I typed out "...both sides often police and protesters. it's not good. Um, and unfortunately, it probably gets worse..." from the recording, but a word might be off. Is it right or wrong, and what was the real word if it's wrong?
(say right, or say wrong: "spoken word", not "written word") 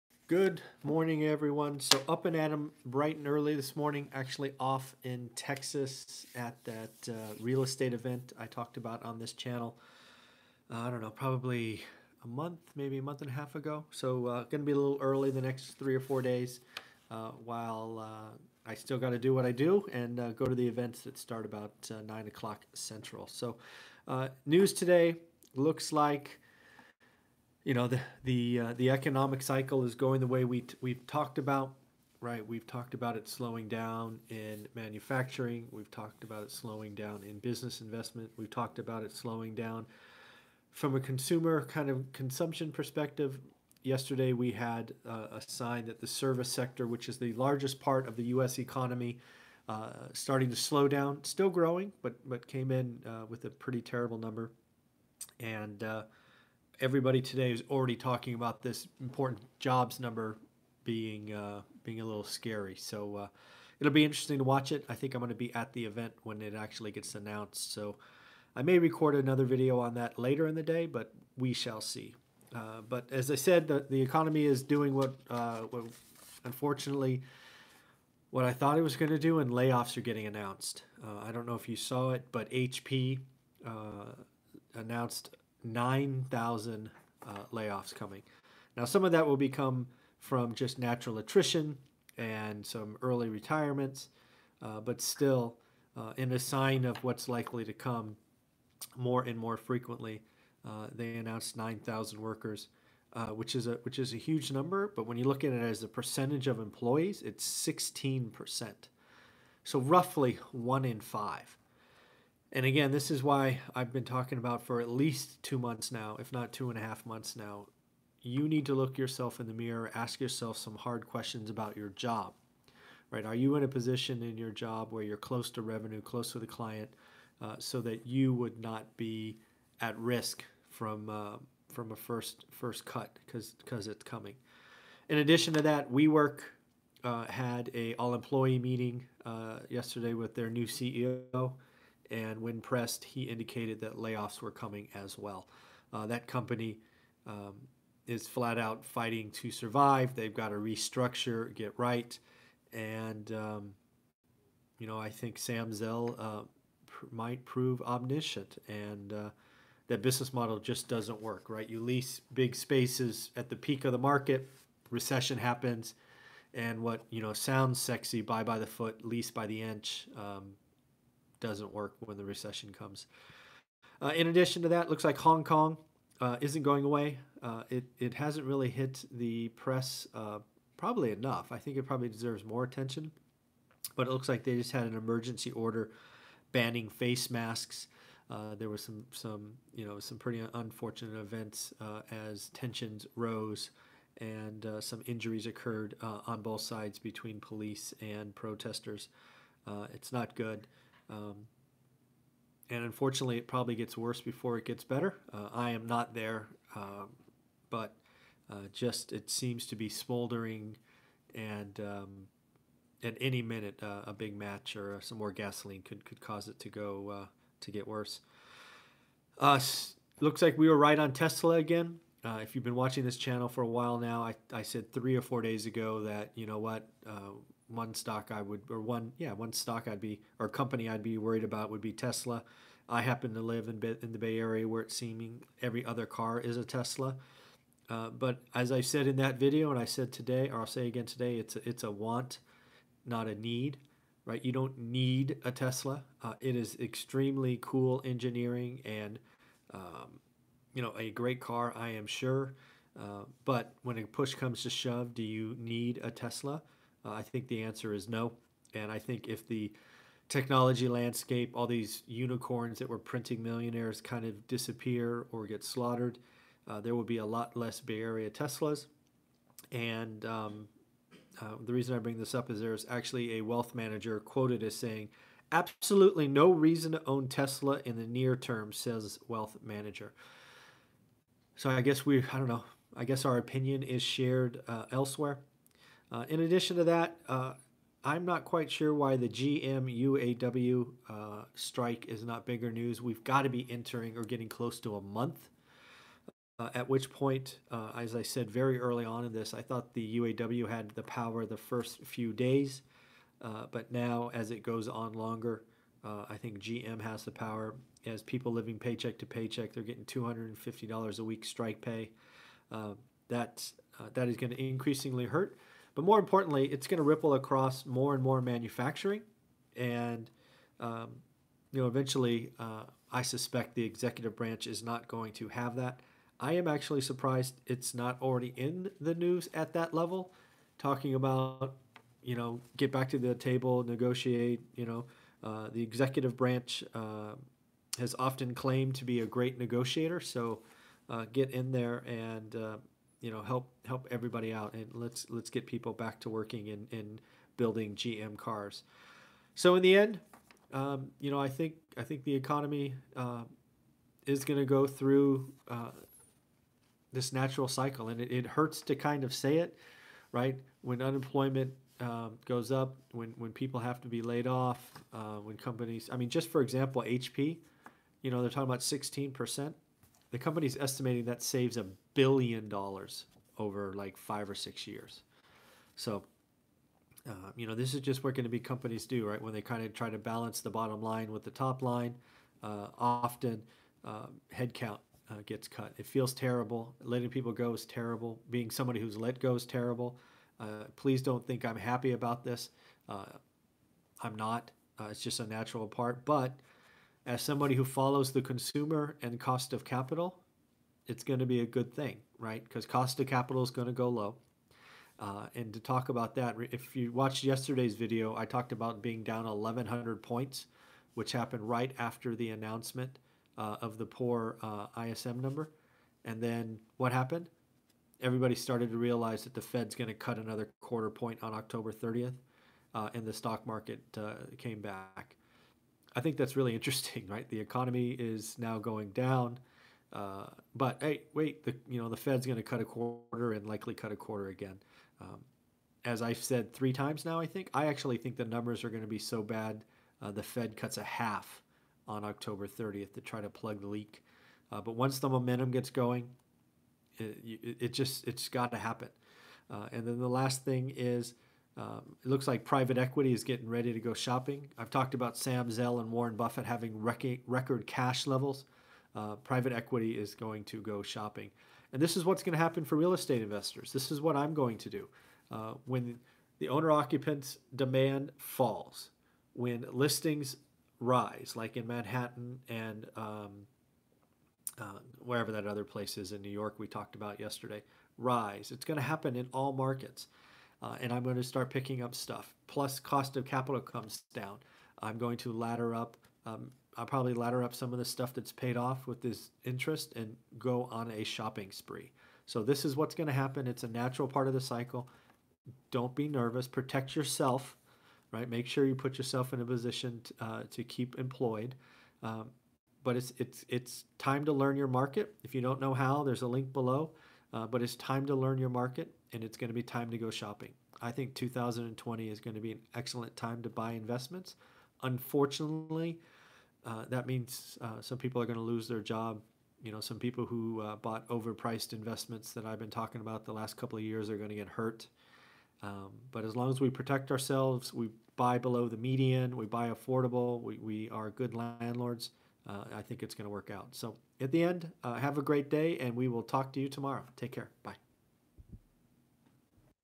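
wrong: "between", not "often".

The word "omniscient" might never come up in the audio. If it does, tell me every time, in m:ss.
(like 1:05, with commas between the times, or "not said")
2:37.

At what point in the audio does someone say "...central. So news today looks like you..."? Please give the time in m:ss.
0:22.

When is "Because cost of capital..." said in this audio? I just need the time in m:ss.
6:42.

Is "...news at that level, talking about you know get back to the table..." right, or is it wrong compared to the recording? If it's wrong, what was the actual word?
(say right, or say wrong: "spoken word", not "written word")
right.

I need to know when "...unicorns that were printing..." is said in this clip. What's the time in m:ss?
4:22.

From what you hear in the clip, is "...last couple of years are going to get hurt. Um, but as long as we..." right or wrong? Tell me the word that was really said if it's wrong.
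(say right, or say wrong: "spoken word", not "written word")
right.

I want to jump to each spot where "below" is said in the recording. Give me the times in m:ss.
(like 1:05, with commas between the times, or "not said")
8:26, 8:48.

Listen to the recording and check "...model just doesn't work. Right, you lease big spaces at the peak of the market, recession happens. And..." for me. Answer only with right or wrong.
right.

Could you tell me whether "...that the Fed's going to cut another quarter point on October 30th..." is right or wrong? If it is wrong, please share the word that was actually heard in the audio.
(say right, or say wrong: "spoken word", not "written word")
right.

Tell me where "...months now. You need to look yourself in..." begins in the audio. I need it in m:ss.
1:57.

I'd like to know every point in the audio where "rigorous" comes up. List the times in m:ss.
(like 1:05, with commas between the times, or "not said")
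not said.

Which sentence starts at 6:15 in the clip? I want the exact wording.
So, uh, you know, this is just what going to be companies do, right?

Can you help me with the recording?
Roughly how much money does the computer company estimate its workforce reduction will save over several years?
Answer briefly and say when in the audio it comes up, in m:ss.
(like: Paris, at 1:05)
A billion dollars, at 6:11.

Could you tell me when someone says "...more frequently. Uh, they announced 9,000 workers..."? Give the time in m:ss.
1:39.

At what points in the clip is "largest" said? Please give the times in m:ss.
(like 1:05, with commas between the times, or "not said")
0:47.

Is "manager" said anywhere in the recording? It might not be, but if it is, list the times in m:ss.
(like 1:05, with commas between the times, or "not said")
4:33, 4:39.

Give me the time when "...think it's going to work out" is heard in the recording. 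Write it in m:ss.
8:53.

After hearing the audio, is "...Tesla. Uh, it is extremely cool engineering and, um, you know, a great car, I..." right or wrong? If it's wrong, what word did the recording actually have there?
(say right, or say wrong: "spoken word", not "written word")
right.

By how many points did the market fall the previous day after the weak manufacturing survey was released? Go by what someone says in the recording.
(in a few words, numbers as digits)
1,100.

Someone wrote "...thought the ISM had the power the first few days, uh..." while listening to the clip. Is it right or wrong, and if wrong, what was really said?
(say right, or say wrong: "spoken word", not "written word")
wrong: "UAW", not "ISM".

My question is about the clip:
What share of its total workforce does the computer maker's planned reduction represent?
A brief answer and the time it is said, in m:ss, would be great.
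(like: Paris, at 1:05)
16 percent, at 1:47.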